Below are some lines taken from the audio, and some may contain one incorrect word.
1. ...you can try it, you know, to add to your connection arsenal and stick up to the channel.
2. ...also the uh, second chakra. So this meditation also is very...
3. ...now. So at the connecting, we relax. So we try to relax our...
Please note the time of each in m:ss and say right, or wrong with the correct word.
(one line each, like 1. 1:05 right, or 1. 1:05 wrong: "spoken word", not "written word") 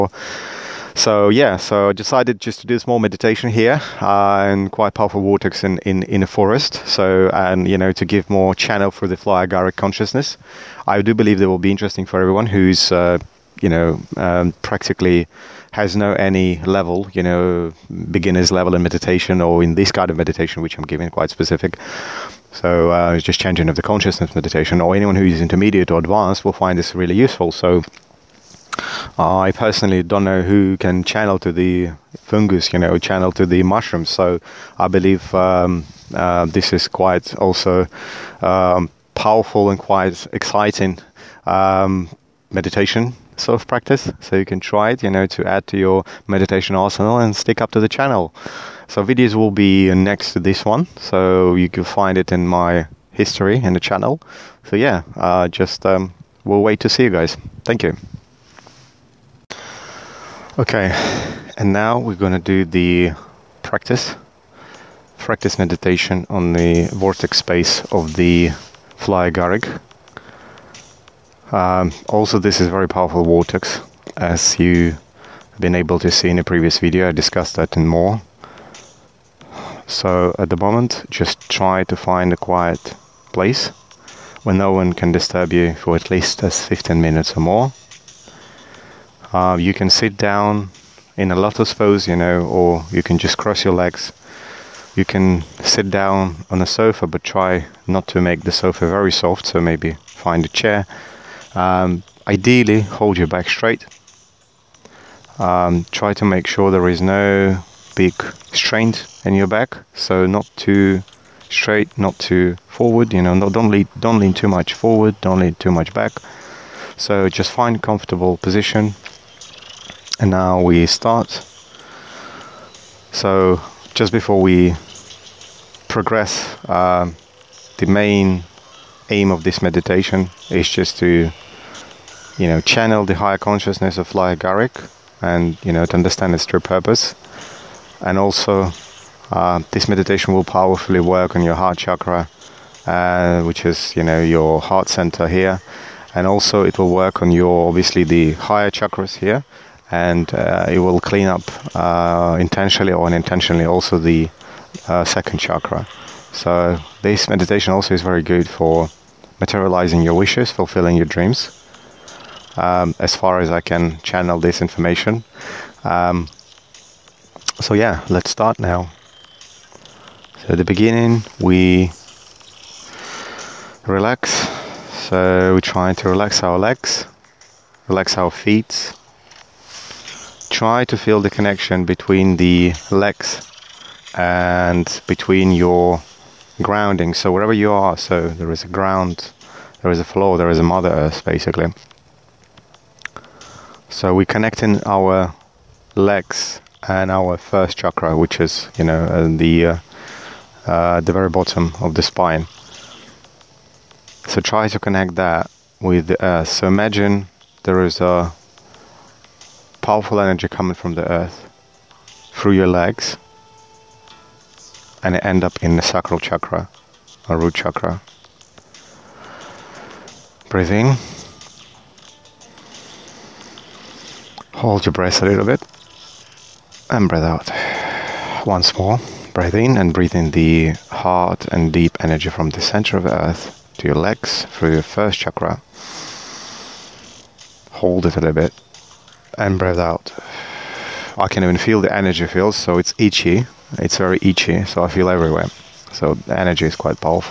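1. 0:44 wrong: "meditation", not "connection"
2. 2:33 right
3. 2:48 wrong: "beginning", not "connecting".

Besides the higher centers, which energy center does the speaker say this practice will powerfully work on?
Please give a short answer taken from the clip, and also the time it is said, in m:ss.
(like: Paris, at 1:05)
Heart chakra, at 2:21.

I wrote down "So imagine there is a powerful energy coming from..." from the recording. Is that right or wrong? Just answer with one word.
right.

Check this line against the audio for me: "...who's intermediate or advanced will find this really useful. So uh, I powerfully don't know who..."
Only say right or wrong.
wrong.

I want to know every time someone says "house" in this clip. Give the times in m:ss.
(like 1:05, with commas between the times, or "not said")
not said.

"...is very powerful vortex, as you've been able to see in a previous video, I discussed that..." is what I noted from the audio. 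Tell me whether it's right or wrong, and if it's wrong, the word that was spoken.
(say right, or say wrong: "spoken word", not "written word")
right.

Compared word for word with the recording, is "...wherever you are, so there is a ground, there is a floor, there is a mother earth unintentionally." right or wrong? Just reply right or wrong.
wrong.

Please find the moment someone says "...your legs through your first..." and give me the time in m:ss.
3:53.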